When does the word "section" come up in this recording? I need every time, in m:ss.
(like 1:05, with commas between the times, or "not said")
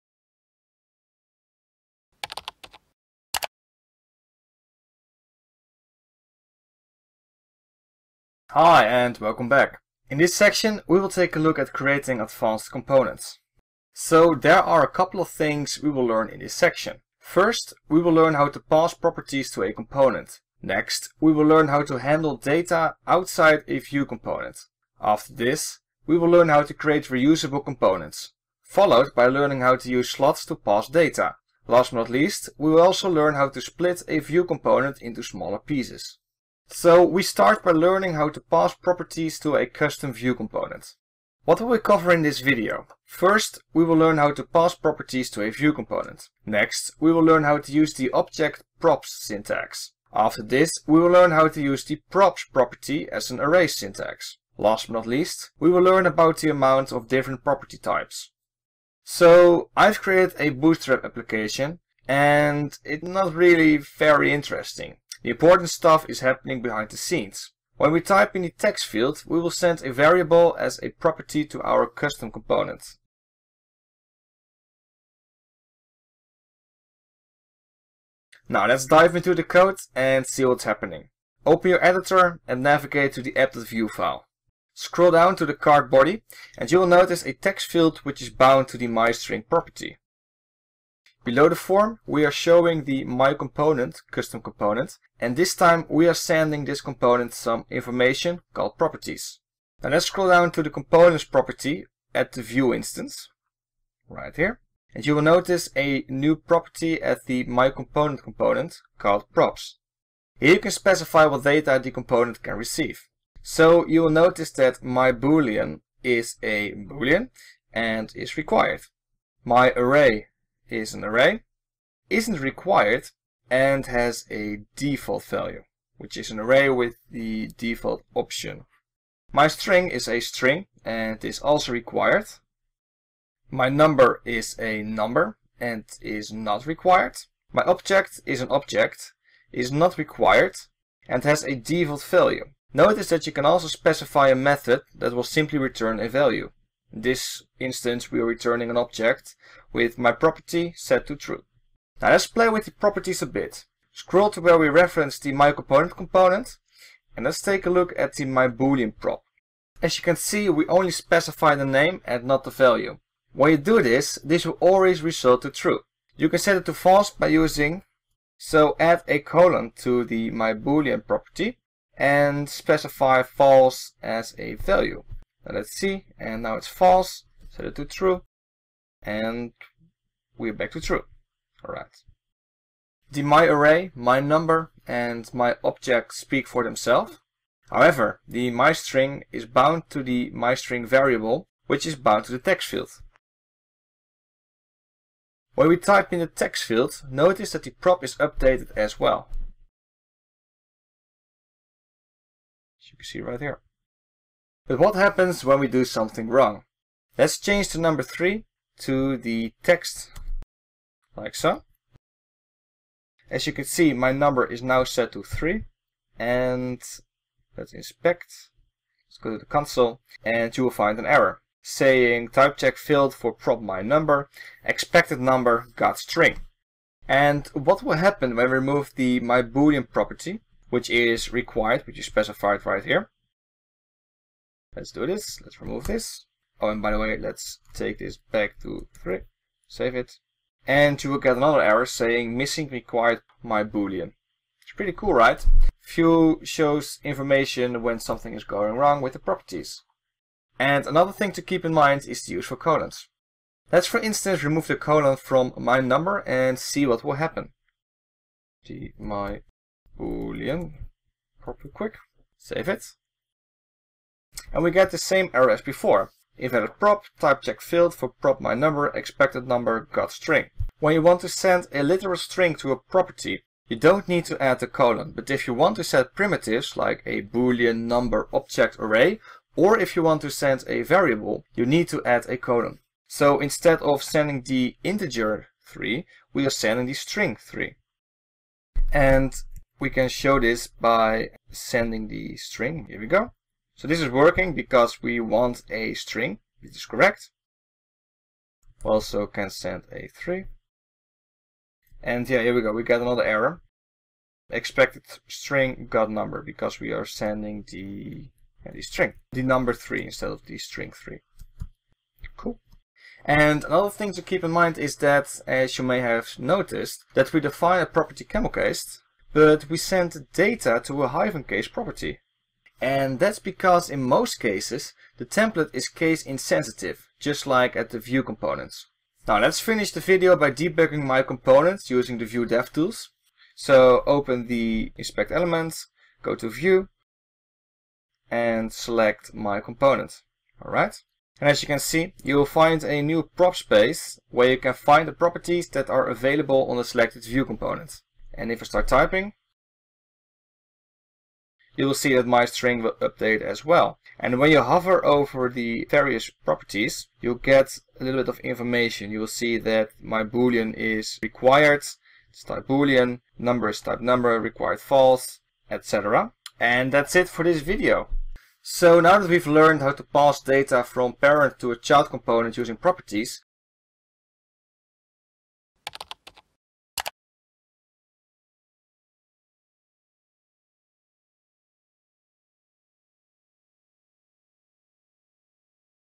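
0:10, 0:16.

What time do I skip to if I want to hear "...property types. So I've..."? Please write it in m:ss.
0:57.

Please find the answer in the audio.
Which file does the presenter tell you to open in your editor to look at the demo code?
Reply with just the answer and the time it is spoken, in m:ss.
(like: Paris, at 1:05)
app.vue, at 1:23.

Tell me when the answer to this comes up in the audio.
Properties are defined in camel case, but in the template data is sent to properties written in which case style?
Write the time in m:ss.
5:21.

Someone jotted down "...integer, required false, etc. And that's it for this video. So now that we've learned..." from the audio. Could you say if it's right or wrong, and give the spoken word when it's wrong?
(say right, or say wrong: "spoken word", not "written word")
wrong: "number", not "integer".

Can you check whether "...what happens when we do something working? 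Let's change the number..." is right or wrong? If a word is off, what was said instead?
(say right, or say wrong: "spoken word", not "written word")
wrong: "wrong", not "working".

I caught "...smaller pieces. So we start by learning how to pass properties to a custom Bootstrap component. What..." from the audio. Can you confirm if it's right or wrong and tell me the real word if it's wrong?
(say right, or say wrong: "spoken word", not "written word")
wrong: "Vue", not "Bootstrap".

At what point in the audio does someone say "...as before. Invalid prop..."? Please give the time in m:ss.
4:25.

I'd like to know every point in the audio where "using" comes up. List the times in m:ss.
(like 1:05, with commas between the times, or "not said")
2:47, 5:31, 6:12.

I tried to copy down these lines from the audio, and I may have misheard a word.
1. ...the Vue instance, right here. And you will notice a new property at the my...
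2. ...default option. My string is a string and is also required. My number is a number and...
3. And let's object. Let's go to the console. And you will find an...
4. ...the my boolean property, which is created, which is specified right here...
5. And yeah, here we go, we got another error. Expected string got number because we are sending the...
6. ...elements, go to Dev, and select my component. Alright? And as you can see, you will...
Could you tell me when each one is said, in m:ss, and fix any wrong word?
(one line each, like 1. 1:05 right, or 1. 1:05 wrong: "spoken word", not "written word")
1. 1:42 right
2. 2:07 right
3. 3:36 wrong: "inspect", not "object"
4. 3:48 wrong: "required", not "created"
5. 5:02 right
6. 5:35 wrong: "Vue", not "Dev".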